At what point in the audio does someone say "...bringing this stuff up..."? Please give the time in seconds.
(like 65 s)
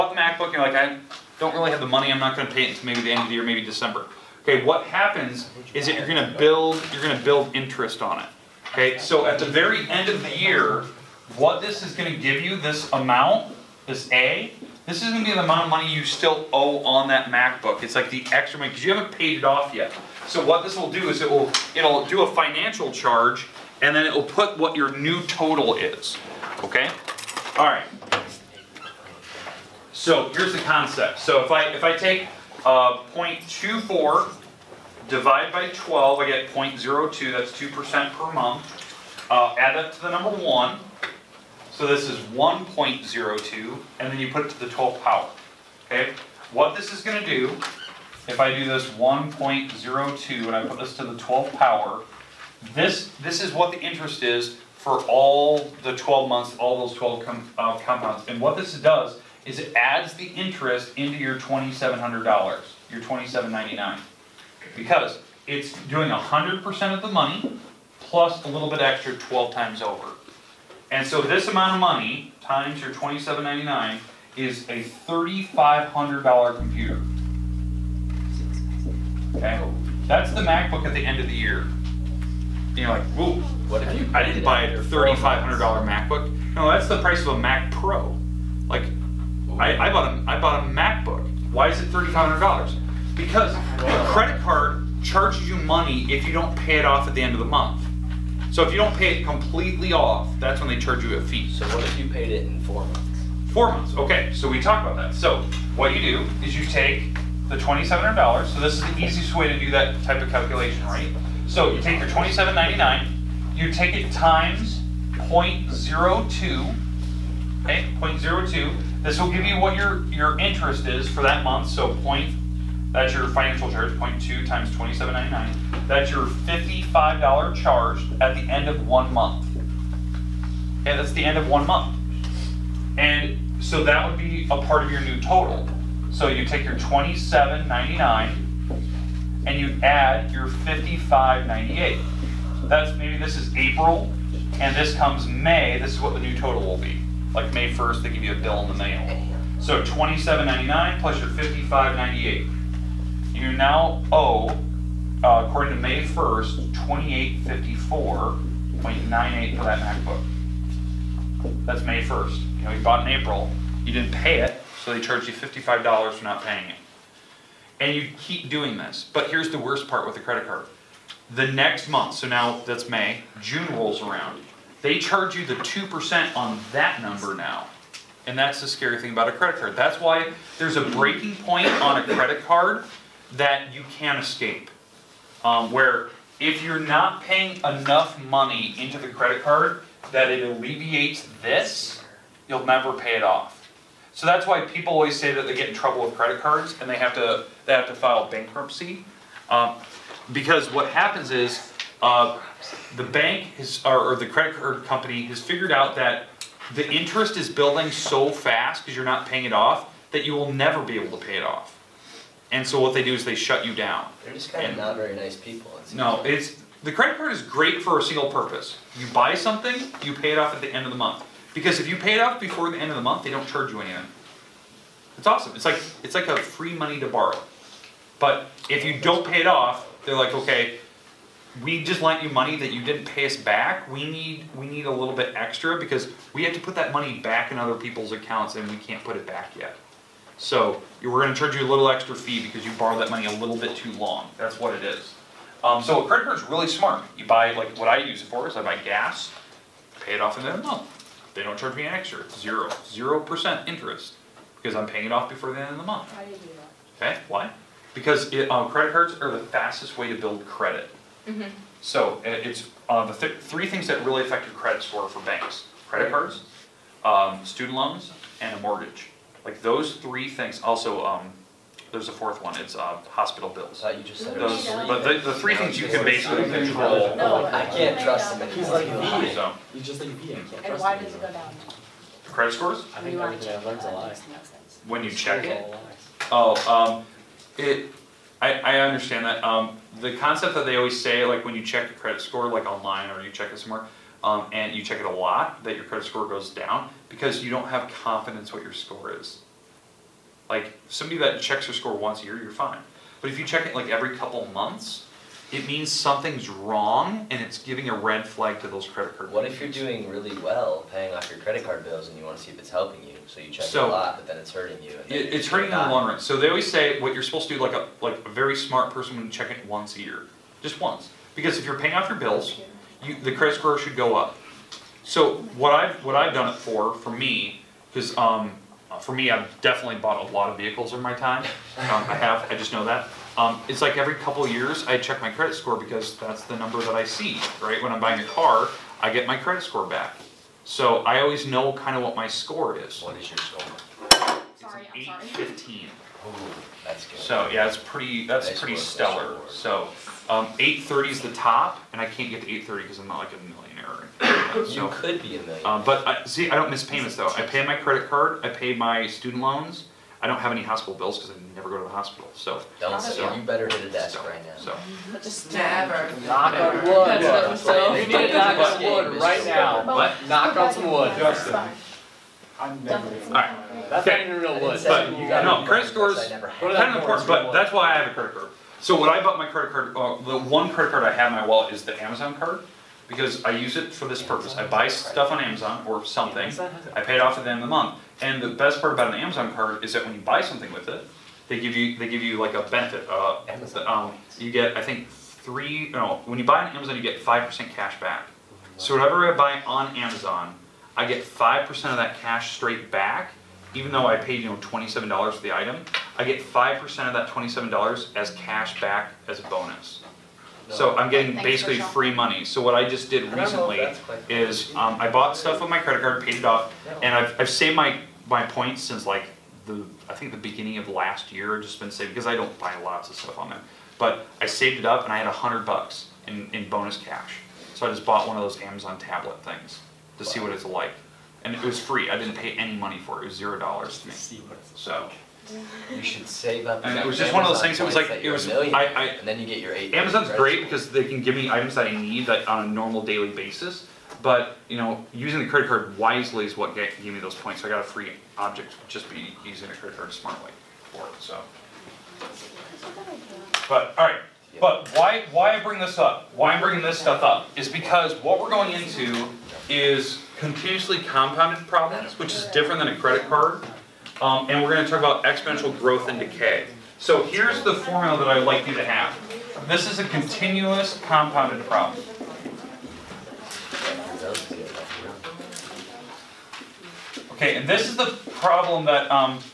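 456 s.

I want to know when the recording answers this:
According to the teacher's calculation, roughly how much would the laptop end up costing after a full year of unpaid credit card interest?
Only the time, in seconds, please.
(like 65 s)
74 s.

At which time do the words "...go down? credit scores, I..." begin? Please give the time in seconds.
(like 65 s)
281 s.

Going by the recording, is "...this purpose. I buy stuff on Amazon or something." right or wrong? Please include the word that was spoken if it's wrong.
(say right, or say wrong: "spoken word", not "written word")
right.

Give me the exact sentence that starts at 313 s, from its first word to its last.
So you check so, it a lot, but then it's hurting you.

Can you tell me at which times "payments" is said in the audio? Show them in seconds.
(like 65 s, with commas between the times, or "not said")
356 s.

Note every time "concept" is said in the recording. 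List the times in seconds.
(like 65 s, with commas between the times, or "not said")
30 s, 290 s.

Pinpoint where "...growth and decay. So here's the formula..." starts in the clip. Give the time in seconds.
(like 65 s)
465 s.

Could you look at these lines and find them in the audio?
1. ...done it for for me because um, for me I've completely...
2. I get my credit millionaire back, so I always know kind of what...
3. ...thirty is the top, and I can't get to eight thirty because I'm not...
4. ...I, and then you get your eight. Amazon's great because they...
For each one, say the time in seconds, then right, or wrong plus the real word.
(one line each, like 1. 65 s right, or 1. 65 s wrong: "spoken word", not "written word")
1. 326 s wrong: "definitely", not "completely"
2. 339 s wrong: "score", not "millionaire"
3. 350 s right
4. 438 s right.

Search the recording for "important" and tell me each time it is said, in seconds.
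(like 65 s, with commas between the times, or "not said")
376 s.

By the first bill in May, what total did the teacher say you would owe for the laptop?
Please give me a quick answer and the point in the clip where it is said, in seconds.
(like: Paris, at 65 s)
$2,854.98, at 156 s.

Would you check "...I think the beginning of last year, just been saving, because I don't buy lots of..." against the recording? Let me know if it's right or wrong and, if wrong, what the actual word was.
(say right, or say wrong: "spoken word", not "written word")
right.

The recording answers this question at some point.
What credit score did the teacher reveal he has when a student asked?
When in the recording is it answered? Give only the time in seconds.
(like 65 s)
345 s.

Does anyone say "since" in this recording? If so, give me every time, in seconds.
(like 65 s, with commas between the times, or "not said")
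418 s.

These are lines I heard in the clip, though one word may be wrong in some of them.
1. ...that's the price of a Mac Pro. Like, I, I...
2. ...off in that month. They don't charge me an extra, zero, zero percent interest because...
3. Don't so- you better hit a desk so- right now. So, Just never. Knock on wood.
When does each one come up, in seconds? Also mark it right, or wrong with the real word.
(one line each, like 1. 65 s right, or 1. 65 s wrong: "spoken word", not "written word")
1. 86 s right
2. 250 s right
3. 362 s right.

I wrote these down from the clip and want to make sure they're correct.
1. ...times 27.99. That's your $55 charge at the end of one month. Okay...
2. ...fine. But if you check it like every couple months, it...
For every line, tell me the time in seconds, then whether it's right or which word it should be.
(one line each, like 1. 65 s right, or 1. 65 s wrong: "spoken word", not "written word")
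1. 124 s right
2. 302 s right.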